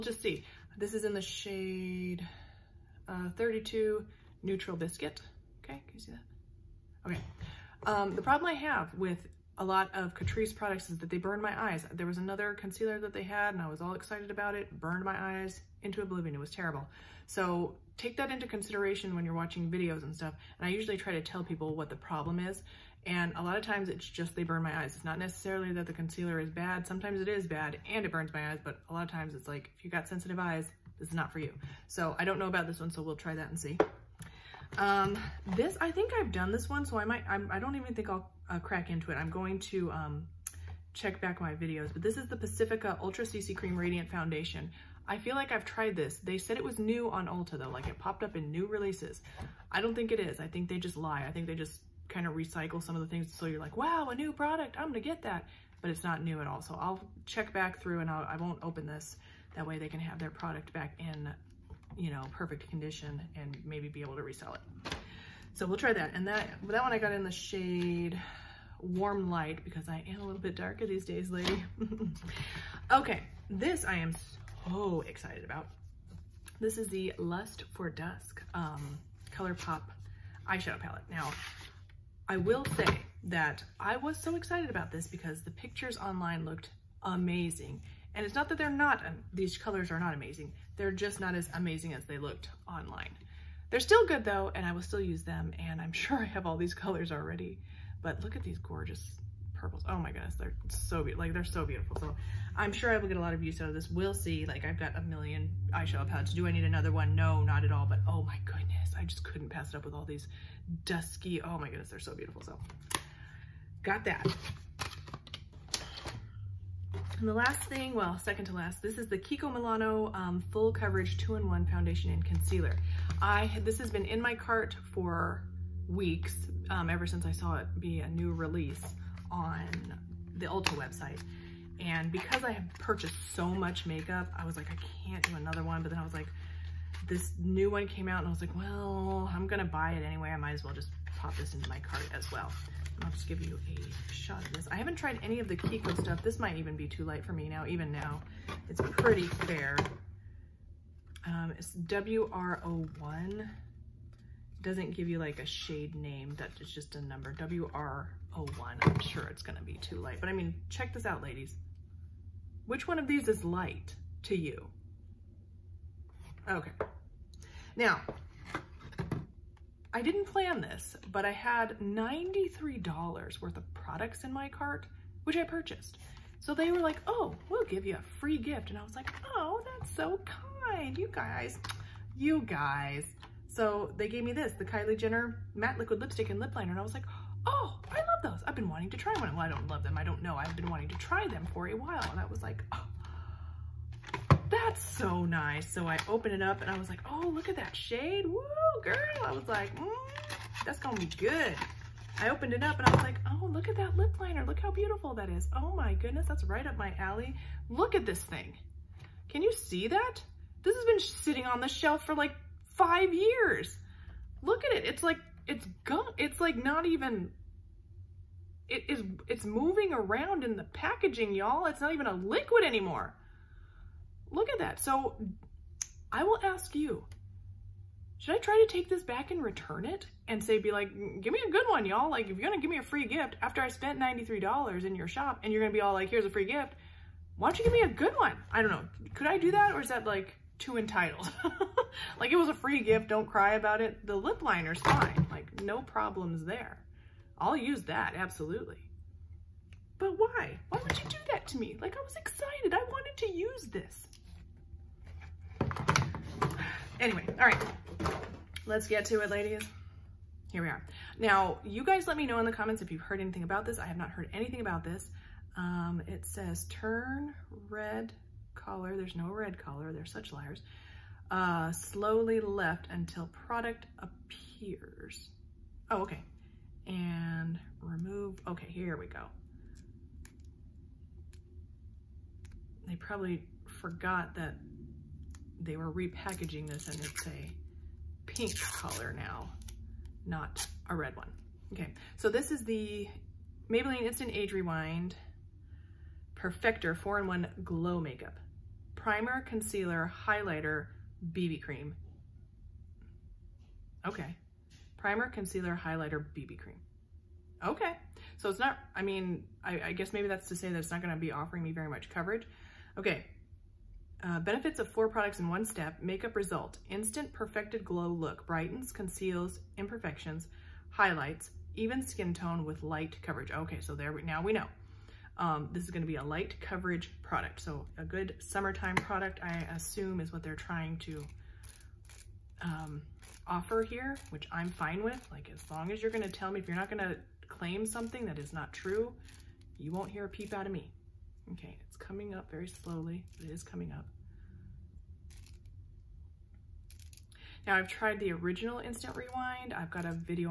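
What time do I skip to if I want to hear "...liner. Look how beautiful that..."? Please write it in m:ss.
3:24.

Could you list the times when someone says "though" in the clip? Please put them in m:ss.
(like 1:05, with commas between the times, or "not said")
0:47, 1:34.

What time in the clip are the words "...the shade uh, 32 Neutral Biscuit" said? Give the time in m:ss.
0:01.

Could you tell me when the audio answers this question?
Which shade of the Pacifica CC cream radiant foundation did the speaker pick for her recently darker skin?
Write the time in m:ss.
1:08.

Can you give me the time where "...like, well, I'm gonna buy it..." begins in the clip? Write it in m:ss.
2:18.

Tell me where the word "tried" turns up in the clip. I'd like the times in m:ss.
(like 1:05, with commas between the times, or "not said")
0:45, 2:24, 5:47.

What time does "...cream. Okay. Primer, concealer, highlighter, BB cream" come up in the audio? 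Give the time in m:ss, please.
5:01.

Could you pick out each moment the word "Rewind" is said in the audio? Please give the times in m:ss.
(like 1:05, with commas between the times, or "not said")
4:54, 5:49.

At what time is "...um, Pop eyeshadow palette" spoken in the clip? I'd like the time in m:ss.
1:18.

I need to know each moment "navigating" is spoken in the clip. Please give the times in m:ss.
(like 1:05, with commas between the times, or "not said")
not said.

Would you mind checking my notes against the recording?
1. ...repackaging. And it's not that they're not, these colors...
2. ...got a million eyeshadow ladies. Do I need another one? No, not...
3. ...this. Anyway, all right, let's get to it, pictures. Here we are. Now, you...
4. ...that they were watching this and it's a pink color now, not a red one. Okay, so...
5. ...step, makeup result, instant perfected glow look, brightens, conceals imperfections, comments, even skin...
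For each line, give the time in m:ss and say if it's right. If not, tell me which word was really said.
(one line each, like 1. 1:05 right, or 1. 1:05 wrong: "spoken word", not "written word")
1. 1:27 wrong: "amazing", not "repackaging"
2. 1:44 wrong: "palettes", not "ladies"
3. 4:13 wrong: "ladies", not "pictures"
4. 4:44 wrong: "repackaging", not "watching"
5. 5:15 wrong: "highlights", not "comments".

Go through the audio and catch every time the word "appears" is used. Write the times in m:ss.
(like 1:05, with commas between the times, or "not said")
4:33.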